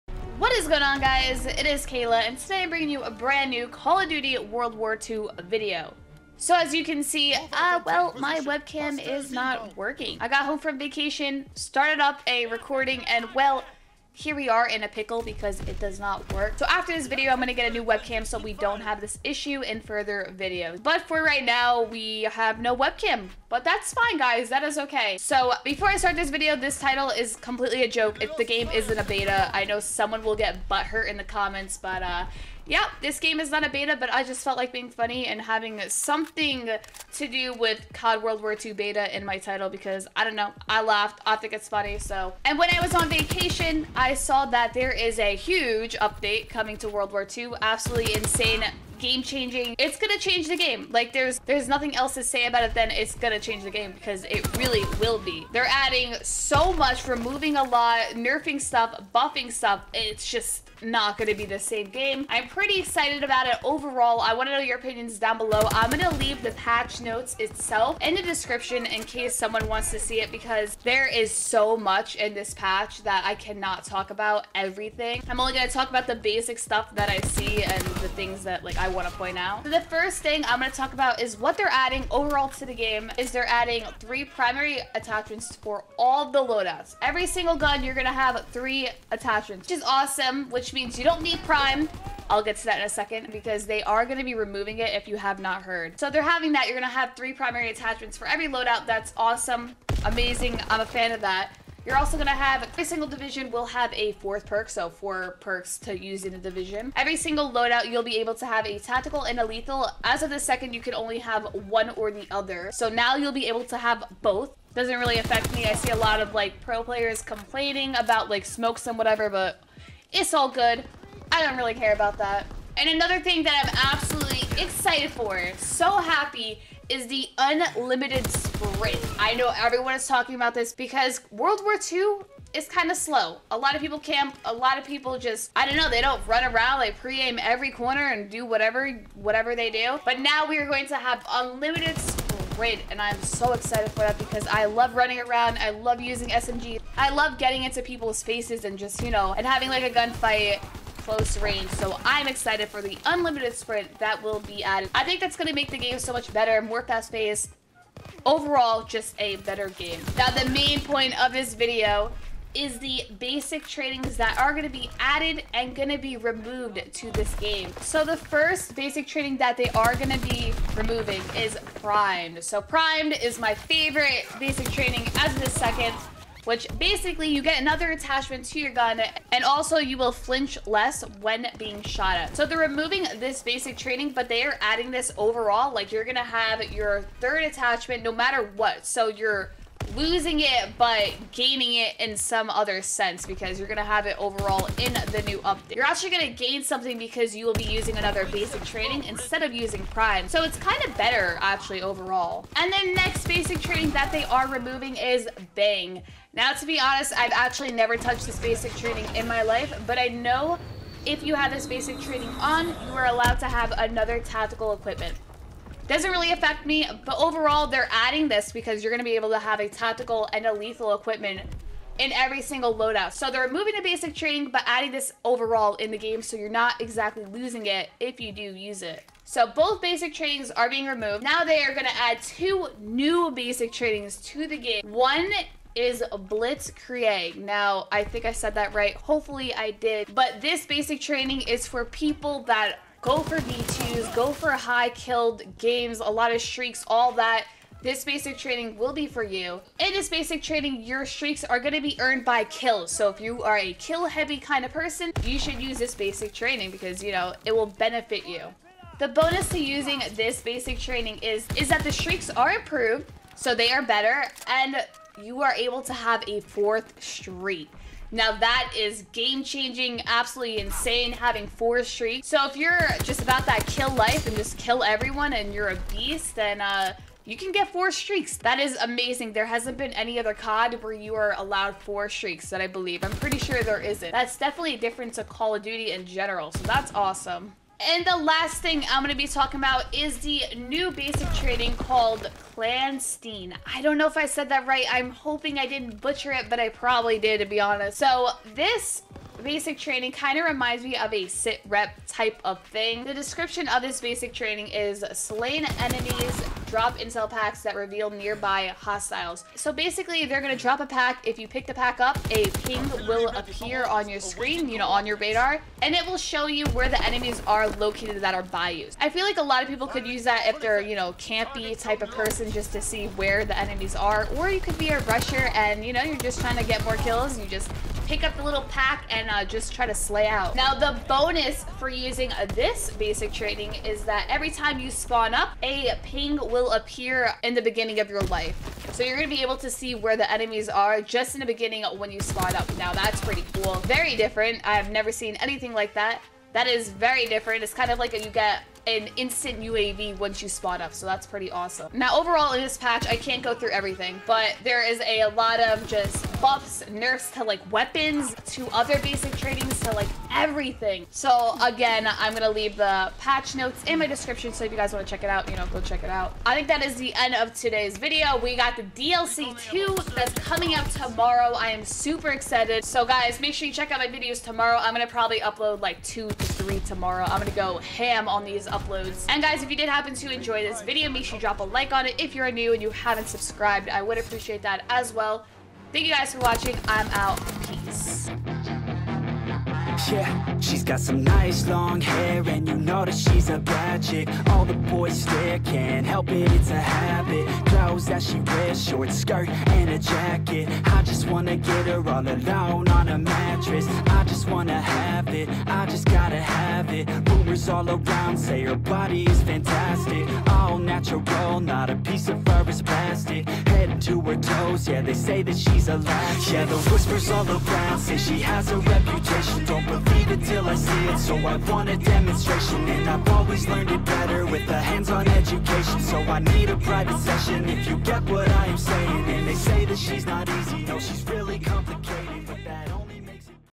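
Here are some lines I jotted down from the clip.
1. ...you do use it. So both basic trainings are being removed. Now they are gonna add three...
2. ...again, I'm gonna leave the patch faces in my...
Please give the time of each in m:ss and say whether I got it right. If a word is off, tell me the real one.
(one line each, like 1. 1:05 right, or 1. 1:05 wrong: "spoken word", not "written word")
1. 3:48 wrong: "two", not "three"
2. 6:01 wrong: "notes", not "faces".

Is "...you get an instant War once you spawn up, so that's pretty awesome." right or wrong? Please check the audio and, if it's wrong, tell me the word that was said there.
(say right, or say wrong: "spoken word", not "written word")
wrong: "UAV", not "War".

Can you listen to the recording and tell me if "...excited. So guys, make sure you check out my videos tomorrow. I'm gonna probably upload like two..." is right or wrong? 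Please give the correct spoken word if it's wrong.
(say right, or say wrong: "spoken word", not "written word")
right.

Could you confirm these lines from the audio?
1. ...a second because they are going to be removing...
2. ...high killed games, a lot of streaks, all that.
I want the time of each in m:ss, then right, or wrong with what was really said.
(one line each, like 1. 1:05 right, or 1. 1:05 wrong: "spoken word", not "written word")
1. 1:32 right
2. 4:04 right.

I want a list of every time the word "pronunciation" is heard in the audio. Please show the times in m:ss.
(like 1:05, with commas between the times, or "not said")
not said.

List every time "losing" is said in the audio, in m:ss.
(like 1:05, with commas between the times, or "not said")
3:09, 3:47.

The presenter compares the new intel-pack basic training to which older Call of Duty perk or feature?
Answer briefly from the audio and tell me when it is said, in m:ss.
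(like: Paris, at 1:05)
Sit rep, at 5:01.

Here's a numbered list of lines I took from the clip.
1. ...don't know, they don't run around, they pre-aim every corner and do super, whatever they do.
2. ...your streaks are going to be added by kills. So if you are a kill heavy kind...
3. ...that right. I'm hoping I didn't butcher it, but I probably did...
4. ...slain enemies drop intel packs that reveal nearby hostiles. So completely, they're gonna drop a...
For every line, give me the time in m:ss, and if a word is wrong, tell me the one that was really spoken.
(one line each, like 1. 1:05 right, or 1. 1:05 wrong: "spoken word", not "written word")
1. 2:15 wrong: "whatever", not "super"
2. 4:10 wrong: "earned", not "added"
3. 4:54 right
4. 5:05 wrong: "basically", not "completely".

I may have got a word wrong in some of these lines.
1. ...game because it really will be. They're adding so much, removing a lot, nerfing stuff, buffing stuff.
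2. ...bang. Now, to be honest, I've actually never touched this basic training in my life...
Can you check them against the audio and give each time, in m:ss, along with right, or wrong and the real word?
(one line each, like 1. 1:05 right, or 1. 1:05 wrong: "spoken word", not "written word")
1. 0:53 right
2. 3:25 right.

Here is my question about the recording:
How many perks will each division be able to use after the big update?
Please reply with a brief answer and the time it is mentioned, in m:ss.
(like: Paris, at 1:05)
4, at 1:44.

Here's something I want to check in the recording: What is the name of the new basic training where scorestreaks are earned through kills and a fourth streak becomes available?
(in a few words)
Blitzkrieg.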